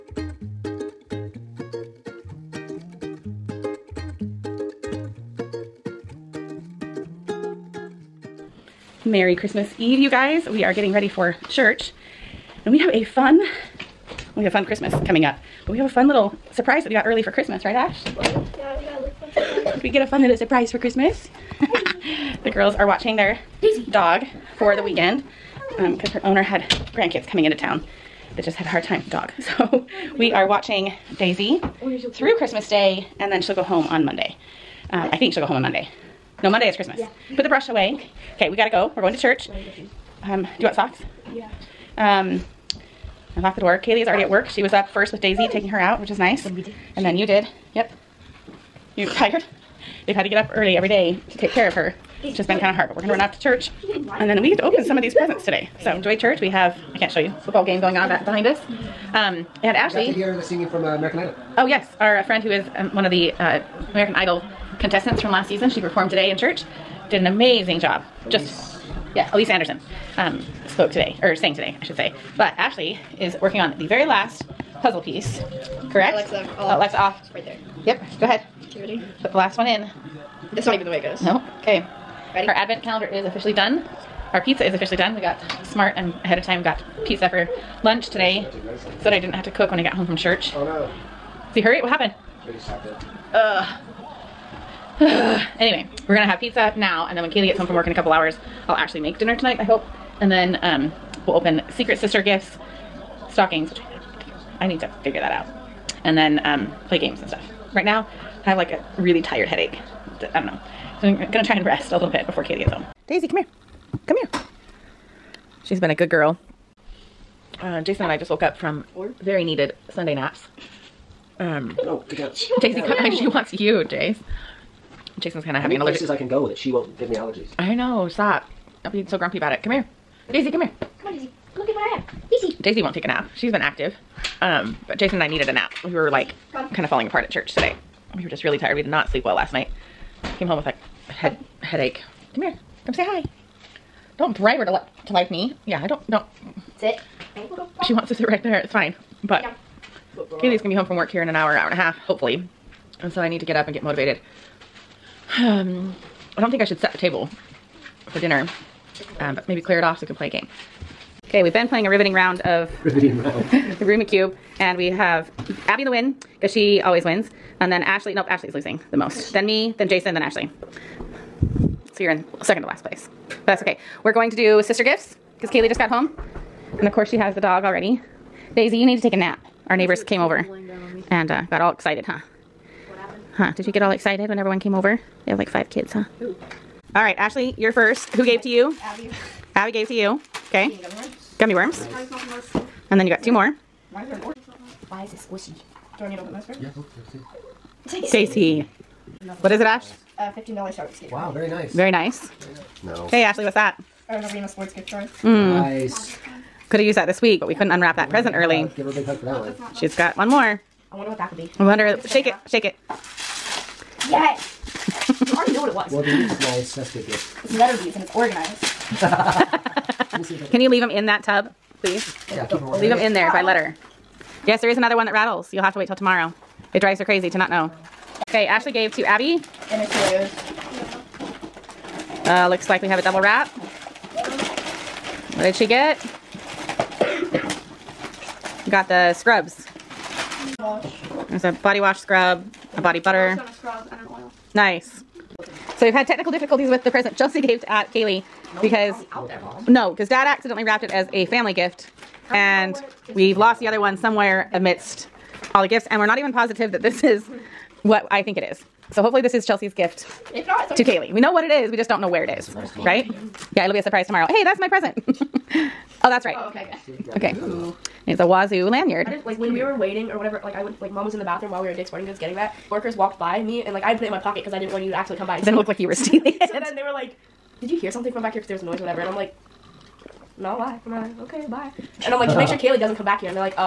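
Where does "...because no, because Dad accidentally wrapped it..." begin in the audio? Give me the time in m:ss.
4:08.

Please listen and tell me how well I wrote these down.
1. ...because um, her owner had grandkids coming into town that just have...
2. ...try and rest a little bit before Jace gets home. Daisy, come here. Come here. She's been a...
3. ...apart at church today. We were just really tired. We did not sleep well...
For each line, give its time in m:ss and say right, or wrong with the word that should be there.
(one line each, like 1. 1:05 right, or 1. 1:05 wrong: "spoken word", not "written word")
1. 0:25 right
2. 1:51 wrong: "Katie", not "Jace"
3. 2:17 right.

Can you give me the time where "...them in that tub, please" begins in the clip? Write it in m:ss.
3:40.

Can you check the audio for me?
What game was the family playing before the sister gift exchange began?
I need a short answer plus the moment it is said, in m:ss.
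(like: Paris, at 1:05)
the Cube, at 2:43.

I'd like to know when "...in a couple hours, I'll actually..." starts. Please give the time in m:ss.
1:37.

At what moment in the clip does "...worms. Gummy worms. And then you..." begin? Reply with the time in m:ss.
3:11.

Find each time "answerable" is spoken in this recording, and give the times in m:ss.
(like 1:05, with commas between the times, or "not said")
not said.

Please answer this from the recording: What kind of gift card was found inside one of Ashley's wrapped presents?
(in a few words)
Arena sports gift card.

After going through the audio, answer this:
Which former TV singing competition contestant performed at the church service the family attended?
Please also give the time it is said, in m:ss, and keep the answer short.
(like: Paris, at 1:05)
Elise Anderson, at 1:09.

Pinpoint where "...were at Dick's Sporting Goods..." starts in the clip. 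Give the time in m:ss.
4:31.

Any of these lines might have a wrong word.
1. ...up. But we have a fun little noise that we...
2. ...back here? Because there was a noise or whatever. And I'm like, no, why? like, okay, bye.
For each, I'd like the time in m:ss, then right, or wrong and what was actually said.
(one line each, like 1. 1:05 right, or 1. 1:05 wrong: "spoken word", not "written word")
1. 0:15 wrong: "surprise", not "noise"
2. 4:38 right.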